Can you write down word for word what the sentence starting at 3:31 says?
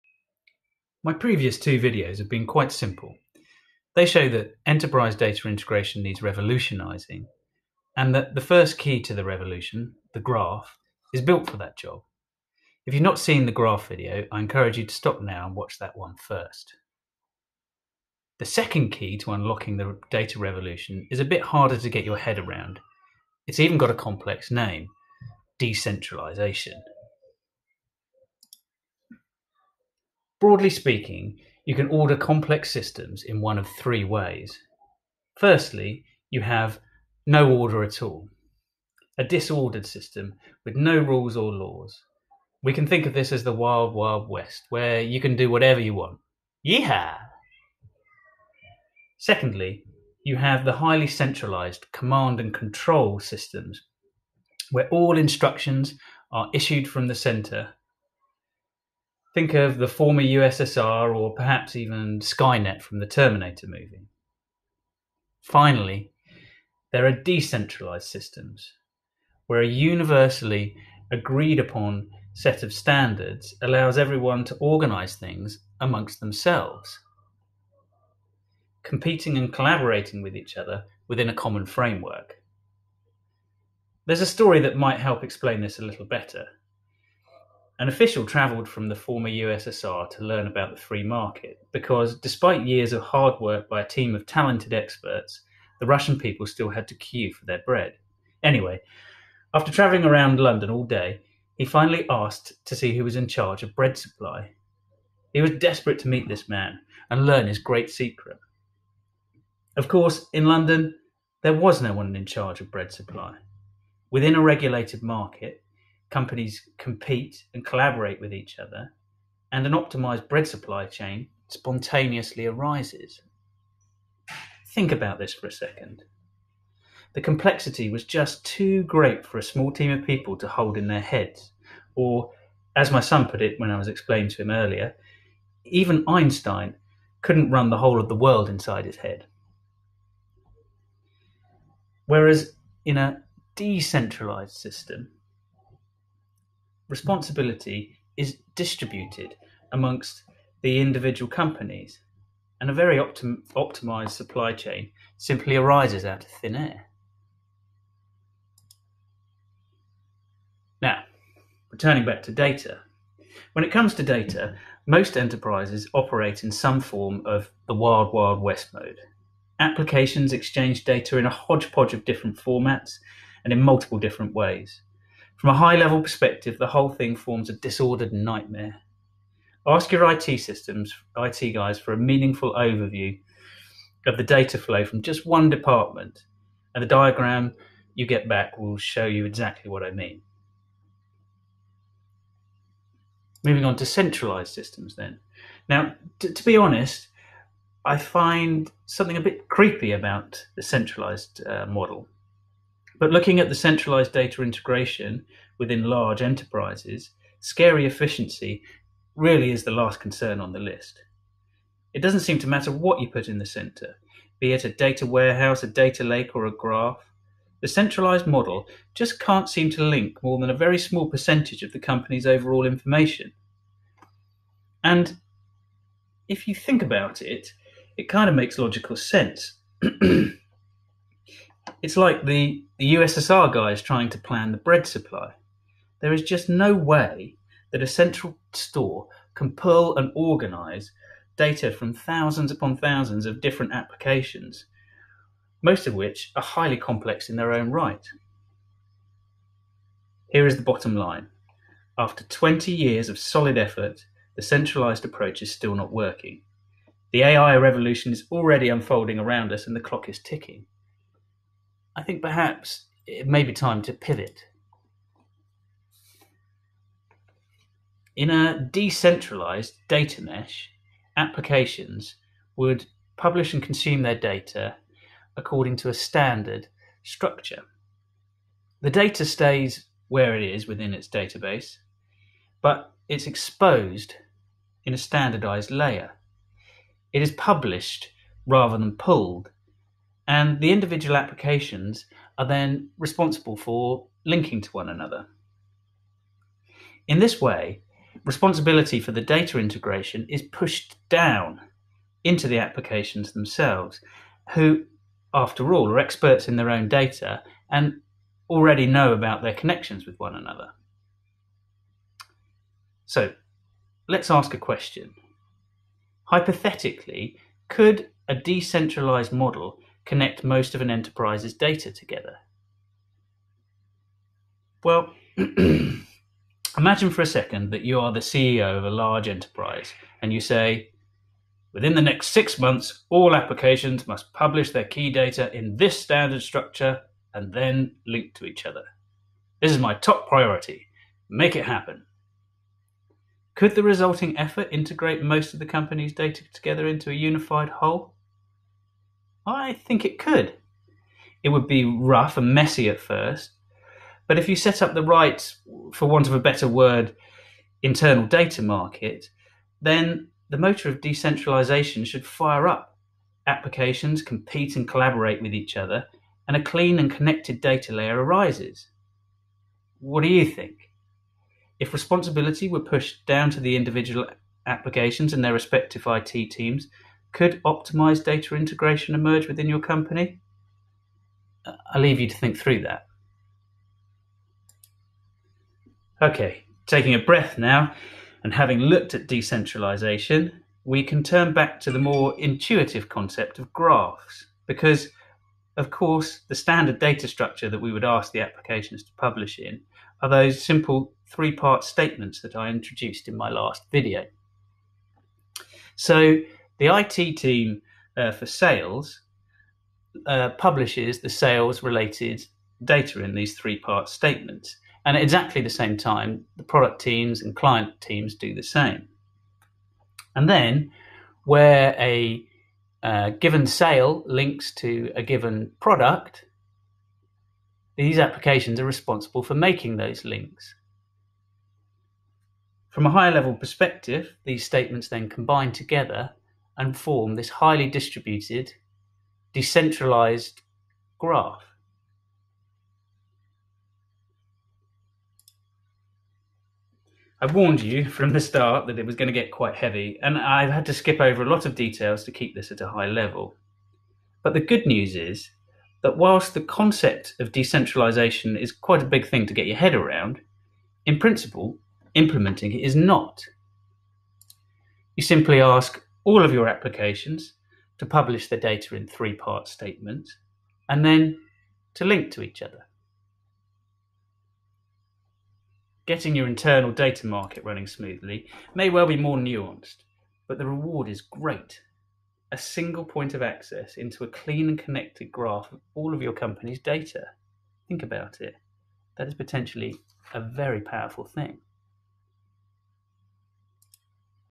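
It doesn't seem to matter what you put in the center, be it a data warehouse, a data lake, or a graph.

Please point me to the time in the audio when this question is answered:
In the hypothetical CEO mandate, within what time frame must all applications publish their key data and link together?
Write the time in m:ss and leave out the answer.
5:32.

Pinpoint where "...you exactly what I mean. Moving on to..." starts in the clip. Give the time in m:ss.
3:09.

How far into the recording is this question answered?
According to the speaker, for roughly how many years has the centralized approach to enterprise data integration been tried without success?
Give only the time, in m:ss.
4:12.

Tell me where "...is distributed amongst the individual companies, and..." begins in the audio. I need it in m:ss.
2:28.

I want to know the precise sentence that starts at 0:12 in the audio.
If you've not seen the graph video, I encourage you to stop now and watch that one first.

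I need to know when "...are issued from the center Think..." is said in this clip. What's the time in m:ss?
0:56.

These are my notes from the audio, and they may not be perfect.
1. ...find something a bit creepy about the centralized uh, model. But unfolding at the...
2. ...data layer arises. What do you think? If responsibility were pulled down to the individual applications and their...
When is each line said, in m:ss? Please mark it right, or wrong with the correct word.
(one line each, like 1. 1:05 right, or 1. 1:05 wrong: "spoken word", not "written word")
1. 3:17 wrong: "looking", not "unfolding"
2. 6:07 wrong: "pushed", not "pulled".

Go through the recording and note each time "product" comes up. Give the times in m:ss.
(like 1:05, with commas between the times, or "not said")
6:56, 7:05.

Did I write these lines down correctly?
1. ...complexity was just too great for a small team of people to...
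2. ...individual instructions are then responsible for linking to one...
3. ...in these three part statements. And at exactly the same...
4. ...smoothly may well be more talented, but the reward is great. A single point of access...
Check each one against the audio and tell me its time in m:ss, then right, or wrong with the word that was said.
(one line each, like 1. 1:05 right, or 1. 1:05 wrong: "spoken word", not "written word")
1. 2:07 right
2. 4:50 wrong: "applications", not "instructions"
3. 6:53 right
4. 7:57 wrong: "nuanced", not "talented".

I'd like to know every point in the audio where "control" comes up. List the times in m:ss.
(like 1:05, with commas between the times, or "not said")
0:52.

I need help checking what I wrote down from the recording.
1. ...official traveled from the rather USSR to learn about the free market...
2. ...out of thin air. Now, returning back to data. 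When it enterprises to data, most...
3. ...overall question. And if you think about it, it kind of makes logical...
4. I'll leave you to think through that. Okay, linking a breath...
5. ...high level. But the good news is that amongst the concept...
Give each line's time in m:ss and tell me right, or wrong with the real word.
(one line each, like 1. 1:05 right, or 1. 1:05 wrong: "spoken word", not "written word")
1. 1:27 wrong: "former", not "rather"
2. 2:36 wrong: "comes", not "enterprises"
3. 3:42 wrong: "information", not "question"
4. 6:21 wrong: "taking", not "linking"
5. 7:32 wrong: "whilst", not "amongst".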